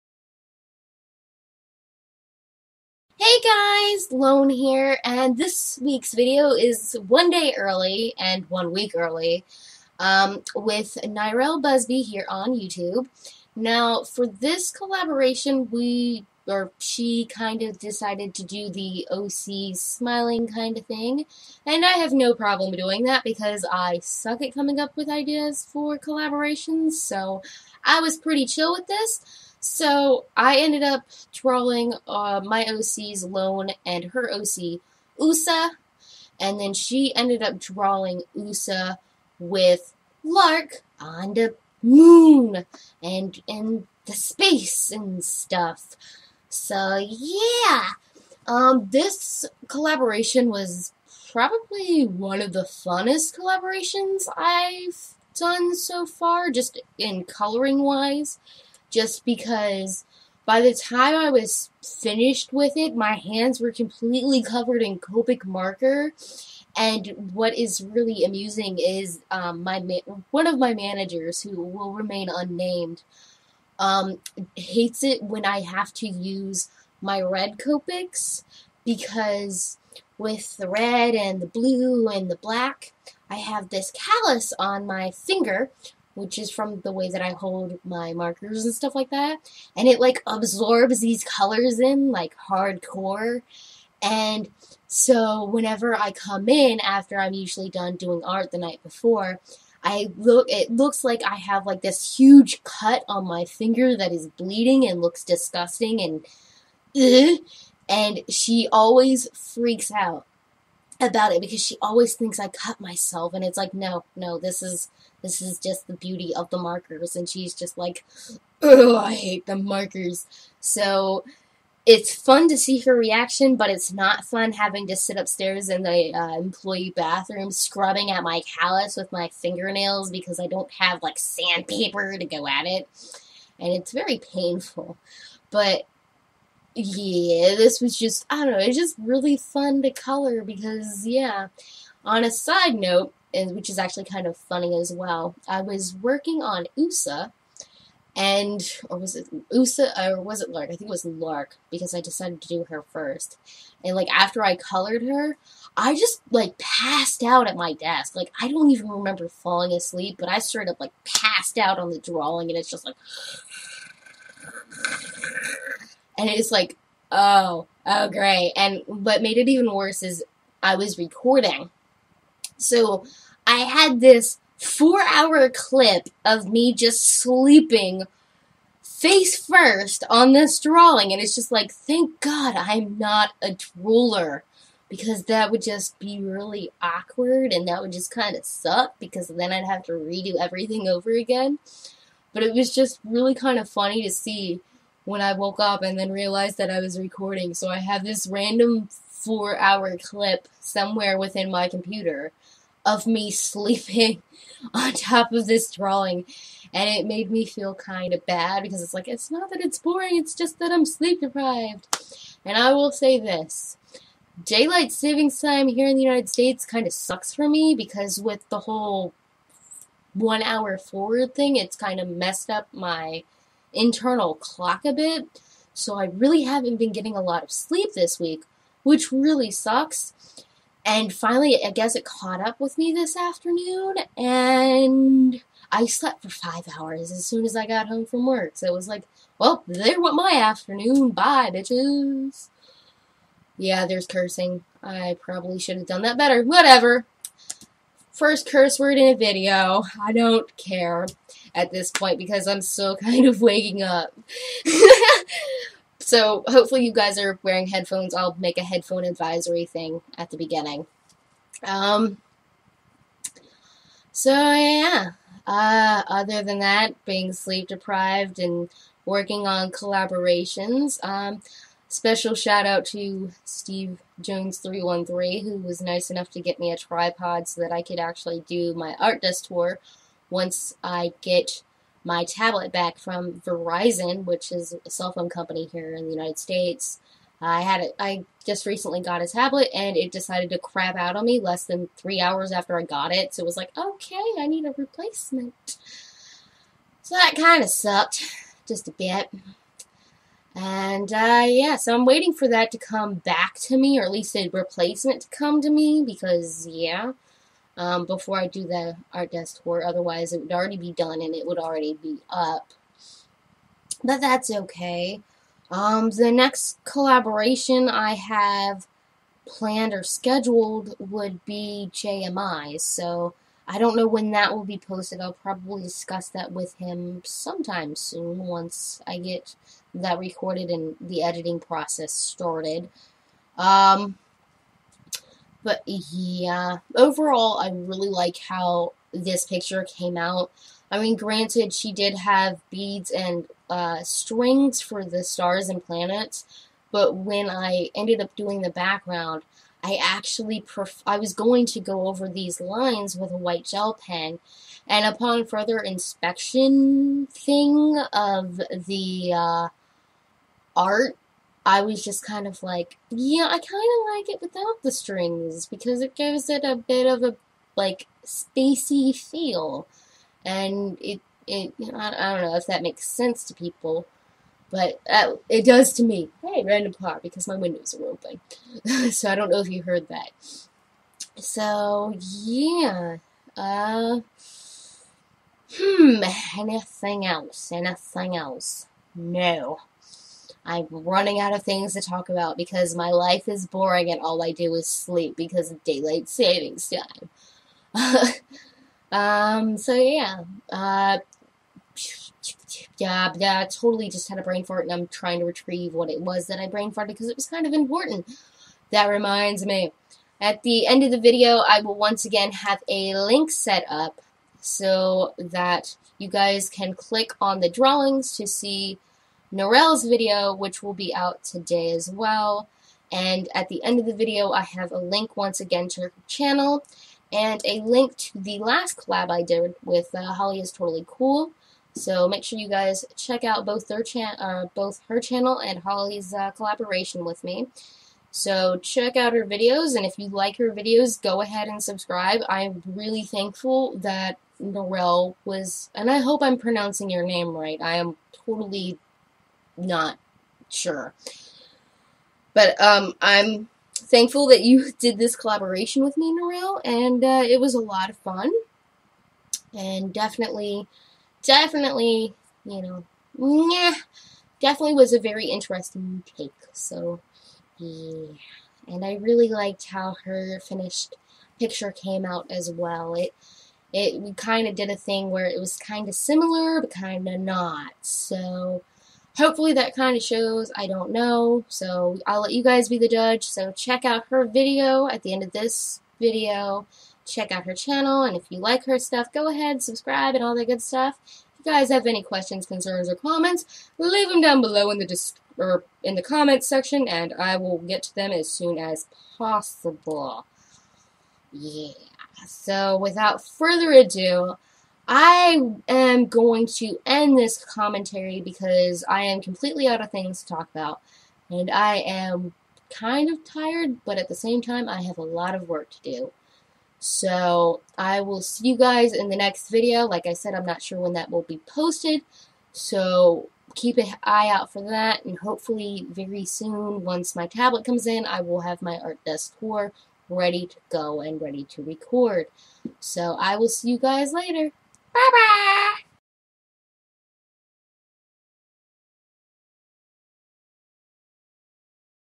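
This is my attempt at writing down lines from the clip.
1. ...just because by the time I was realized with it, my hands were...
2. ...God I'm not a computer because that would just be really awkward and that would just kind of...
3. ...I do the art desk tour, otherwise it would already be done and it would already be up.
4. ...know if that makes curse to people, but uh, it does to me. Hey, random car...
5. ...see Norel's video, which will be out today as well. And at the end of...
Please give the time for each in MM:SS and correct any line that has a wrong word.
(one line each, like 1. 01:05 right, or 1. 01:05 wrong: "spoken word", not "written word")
1. 00:58 wrong: "finished", not "realized"
2. 03:02 wrong: "drooler", not "computer"
3. 05:08 right
4. 06:12 wrong: "sense", not "curse"
5. 06:58 right.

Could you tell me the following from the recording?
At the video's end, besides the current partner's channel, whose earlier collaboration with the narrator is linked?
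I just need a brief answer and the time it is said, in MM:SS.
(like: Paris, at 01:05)
Holly is Totally Cool, at 07:10.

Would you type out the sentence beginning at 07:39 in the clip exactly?
And definitely, definitely, you know, yeah, definitely was a very interesting take.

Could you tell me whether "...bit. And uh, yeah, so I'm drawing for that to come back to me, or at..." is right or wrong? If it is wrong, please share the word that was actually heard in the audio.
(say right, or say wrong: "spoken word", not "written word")
wrong: "waiting", not "drawing".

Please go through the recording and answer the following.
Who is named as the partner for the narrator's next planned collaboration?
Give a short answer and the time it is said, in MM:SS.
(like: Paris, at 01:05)
JMI, at 05:21.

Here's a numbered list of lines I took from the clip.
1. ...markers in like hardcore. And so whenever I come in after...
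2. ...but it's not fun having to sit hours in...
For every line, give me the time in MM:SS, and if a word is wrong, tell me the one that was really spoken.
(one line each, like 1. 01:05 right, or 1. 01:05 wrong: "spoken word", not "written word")
1. 01:31 wrong: "colors", not "markers"
2. 02:03 wrong: "upstairs", not "hours".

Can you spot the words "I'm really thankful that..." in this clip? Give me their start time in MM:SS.
07:22.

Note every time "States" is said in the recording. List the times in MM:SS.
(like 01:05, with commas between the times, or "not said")
03:36, 04:46.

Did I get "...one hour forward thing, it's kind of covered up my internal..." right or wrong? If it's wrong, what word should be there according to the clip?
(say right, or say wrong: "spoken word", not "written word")
wrong: "messed", not "covered".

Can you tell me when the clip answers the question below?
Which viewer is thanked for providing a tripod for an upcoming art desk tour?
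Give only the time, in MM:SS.
04:33.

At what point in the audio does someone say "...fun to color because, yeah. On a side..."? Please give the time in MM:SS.
02:19.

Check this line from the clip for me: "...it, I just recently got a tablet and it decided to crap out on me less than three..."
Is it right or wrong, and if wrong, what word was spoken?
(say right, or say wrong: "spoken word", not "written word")
right.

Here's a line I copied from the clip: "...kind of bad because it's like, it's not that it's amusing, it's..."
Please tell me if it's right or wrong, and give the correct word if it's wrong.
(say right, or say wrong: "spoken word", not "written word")
wrong: "boring", not "amusing".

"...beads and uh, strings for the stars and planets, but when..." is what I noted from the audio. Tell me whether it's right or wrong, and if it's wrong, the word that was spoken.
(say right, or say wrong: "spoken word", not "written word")
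right.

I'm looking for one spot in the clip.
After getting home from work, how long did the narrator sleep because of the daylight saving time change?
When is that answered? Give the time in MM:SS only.
03:56.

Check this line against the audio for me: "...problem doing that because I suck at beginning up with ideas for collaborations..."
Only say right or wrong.
wrong.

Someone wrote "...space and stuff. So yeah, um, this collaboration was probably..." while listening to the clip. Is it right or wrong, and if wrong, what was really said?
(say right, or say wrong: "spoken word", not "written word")
right.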